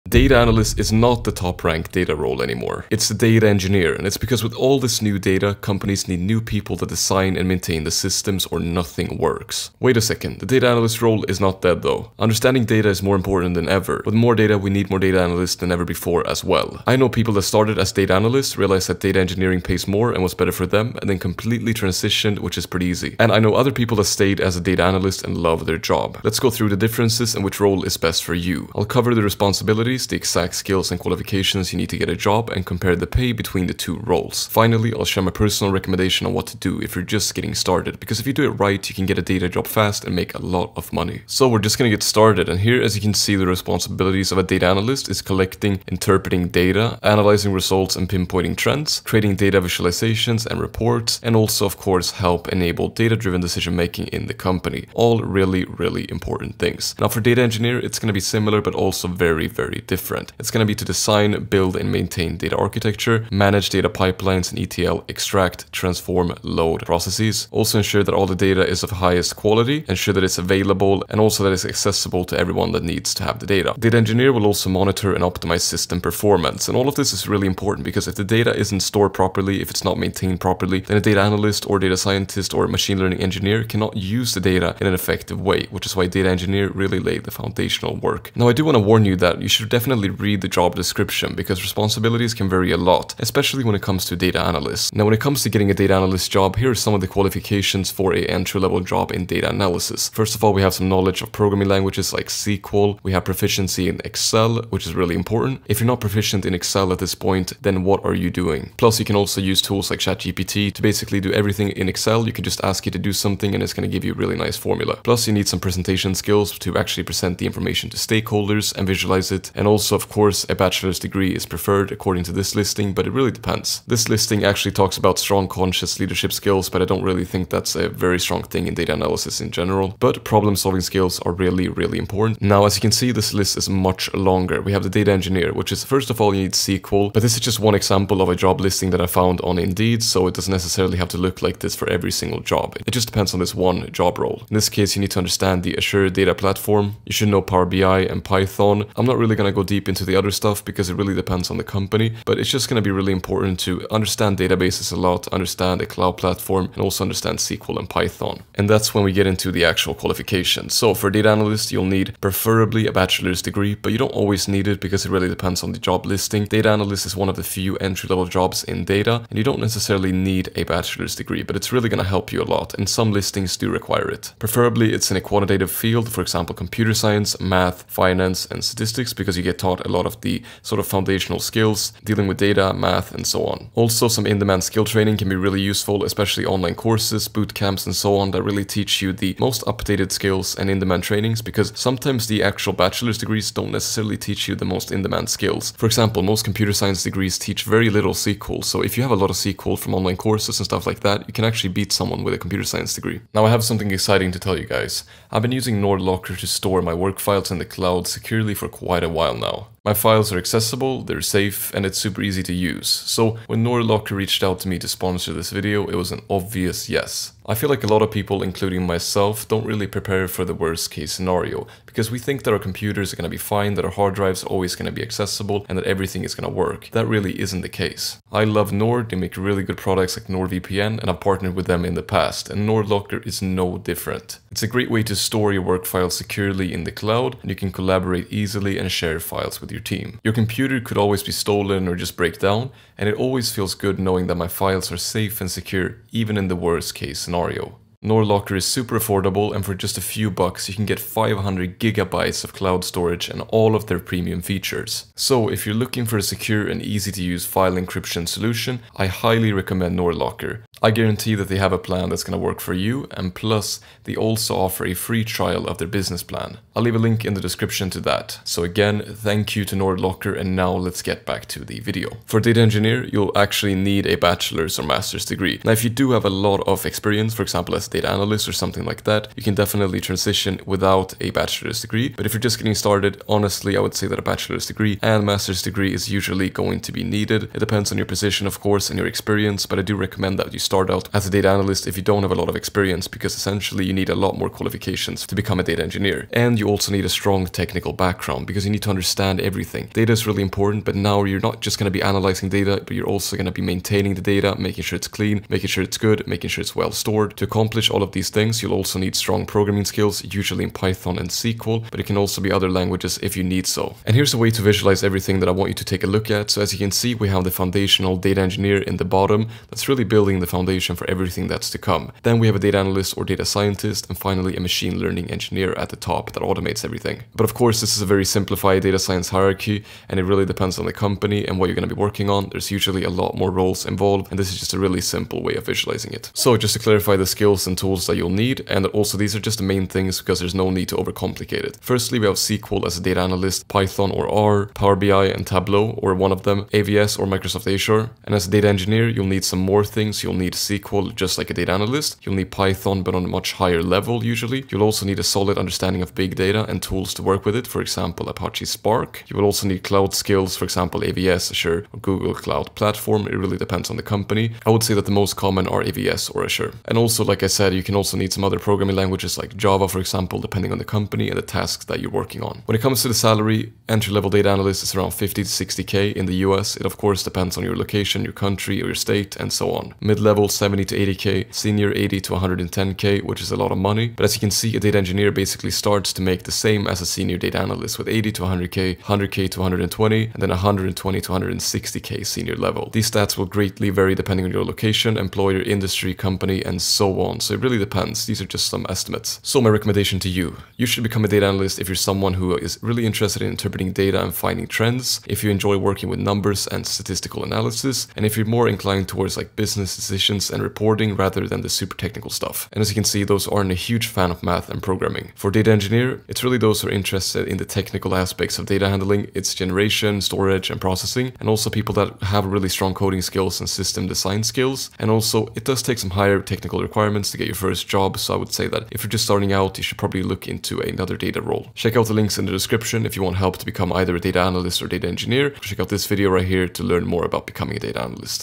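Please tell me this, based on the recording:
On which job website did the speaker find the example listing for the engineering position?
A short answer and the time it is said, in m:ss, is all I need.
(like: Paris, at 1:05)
Indeed, at 2:19.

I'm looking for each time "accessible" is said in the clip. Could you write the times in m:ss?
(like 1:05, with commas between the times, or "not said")
1:11, 3:30, 3:45.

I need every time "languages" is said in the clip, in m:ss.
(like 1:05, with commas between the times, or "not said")
1:41, 5:12, 6:08.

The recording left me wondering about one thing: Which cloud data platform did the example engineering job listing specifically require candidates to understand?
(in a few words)
Azure Data Platform.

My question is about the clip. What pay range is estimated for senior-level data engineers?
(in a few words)
120 to 160k.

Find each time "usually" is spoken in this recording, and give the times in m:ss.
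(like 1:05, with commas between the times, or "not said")
4:46, 5:10, 5:32, 5:54.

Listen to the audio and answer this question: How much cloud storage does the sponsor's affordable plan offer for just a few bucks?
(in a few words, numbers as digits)
500 gigabytes.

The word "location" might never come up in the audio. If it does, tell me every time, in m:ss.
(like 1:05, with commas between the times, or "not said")
6:17, 6:34.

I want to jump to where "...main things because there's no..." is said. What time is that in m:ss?
5:39.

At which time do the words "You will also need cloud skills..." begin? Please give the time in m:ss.
5:59.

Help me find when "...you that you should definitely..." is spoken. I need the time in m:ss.
1:29.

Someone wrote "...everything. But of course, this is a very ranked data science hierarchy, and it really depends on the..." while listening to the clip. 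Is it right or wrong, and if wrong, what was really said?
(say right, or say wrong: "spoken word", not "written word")
wrong: "simplified", not "ranked".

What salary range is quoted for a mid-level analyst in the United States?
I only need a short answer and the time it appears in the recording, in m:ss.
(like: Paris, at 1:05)
70 to 80k, at 6:20.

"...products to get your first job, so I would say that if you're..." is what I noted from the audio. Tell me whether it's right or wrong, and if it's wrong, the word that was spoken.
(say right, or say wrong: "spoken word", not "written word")
wrong: "requirements", not "products".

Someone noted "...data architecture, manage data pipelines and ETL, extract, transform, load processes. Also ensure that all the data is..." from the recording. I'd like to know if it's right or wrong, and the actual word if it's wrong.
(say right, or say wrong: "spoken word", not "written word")
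right.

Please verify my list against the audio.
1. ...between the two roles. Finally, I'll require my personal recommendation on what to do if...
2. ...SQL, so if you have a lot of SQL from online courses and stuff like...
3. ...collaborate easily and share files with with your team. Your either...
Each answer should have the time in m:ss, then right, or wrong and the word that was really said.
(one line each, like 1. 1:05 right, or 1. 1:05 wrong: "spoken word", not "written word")
1. 0:33 wrong: "share", not "require"
2. 3:18 right
3. 3:57 wrong: "computer", not "either".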